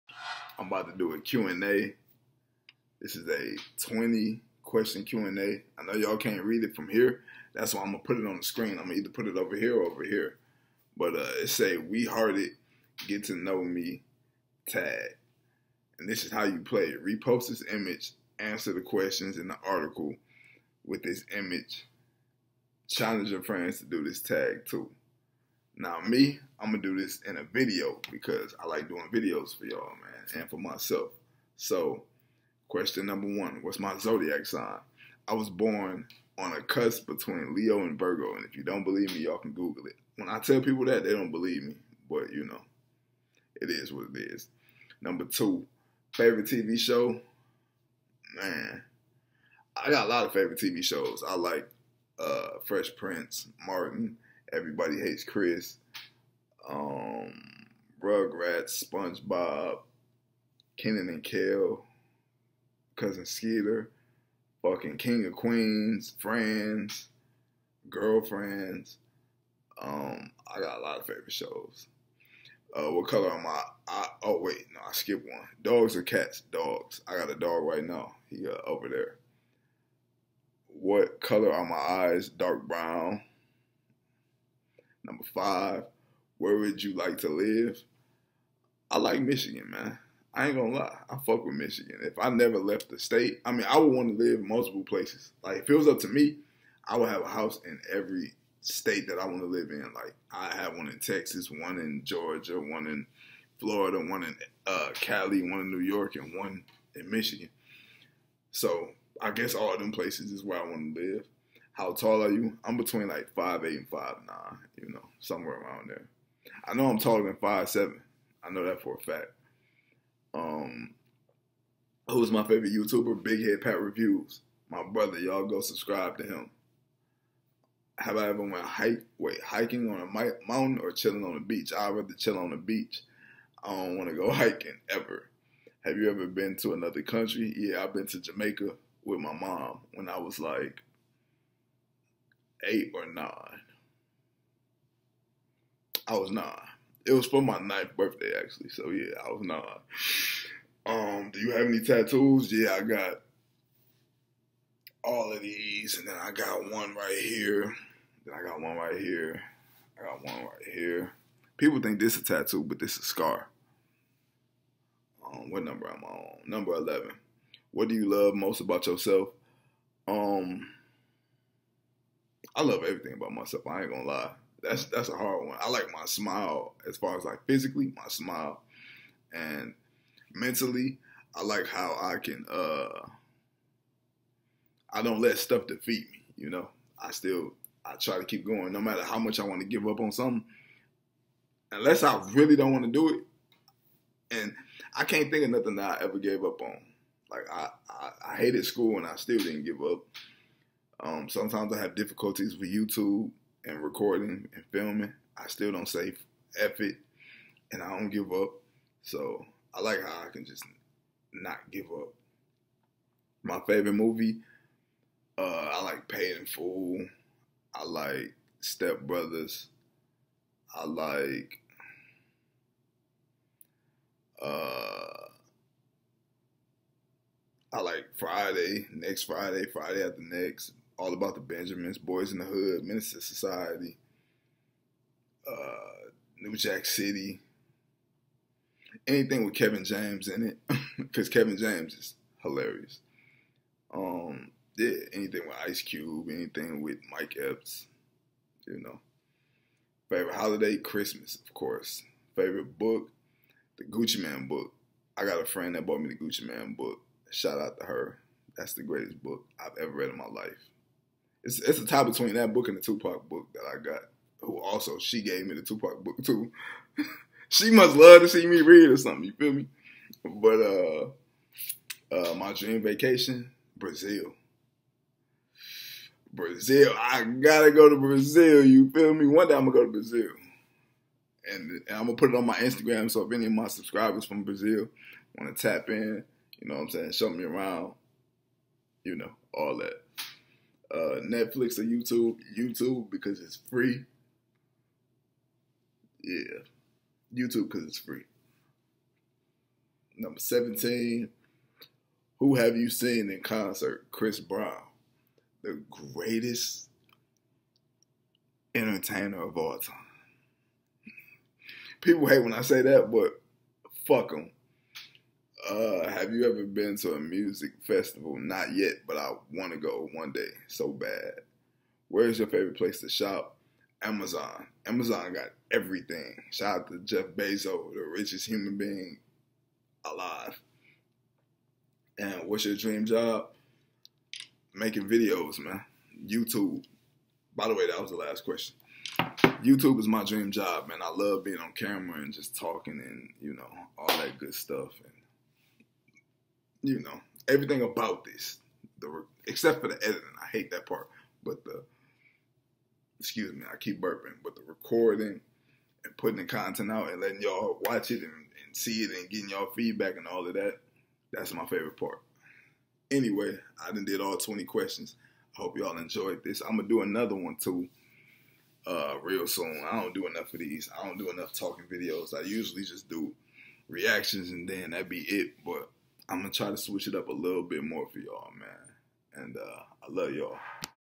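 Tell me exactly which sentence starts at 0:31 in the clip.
So, question number one: What's my zodiac sign?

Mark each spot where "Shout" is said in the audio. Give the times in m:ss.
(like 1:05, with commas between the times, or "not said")
4:17, 5:26.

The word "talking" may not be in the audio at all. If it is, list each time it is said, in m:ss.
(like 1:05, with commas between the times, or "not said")
5:42, 6:11.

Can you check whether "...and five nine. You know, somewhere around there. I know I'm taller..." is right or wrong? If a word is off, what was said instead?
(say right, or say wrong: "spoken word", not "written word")
right.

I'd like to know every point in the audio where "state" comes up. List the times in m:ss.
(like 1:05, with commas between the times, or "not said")
1:32, 1:38.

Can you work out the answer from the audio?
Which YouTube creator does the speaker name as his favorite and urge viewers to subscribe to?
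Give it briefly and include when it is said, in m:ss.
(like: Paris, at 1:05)
Big Head Pat Reviews, at 2:03.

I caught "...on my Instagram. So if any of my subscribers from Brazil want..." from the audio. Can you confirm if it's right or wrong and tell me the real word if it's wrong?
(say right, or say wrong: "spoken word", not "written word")
right.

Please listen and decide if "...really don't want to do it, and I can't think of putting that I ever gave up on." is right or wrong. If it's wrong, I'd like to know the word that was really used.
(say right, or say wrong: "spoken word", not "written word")
wrong: "nothing", not "putting".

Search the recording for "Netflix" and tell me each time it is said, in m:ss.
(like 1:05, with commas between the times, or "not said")
4:51.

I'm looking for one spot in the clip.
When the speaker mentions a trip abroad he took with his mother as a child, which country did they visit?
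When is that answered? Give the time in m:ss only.
2:18.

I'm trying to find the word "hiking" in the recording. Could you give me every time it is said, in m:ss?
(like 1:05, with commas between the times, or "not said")
2:09, 2:14.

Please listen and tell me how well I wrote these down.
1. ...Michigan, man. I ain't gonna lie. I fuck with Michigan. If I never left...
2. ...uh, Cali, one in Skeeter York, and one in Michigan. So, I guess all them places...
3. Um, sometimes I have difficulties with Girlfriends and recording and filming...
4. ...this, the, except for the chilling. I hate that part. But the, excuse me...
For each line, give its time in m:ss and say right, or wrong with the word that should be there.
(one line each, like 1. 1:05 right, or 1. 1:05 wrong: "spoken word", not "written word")
1. 1:29 right
2. 1:44 wrong: "New", not "Skeeter"
3. 3:20 wrong: "YouTube", not "Girlfriends"
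4. 5:48 wrong: "editing", not "chilling".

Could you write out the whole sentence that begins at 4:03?
Um, yeah, anything with Ice Cube, anything with Mike Epps, you know.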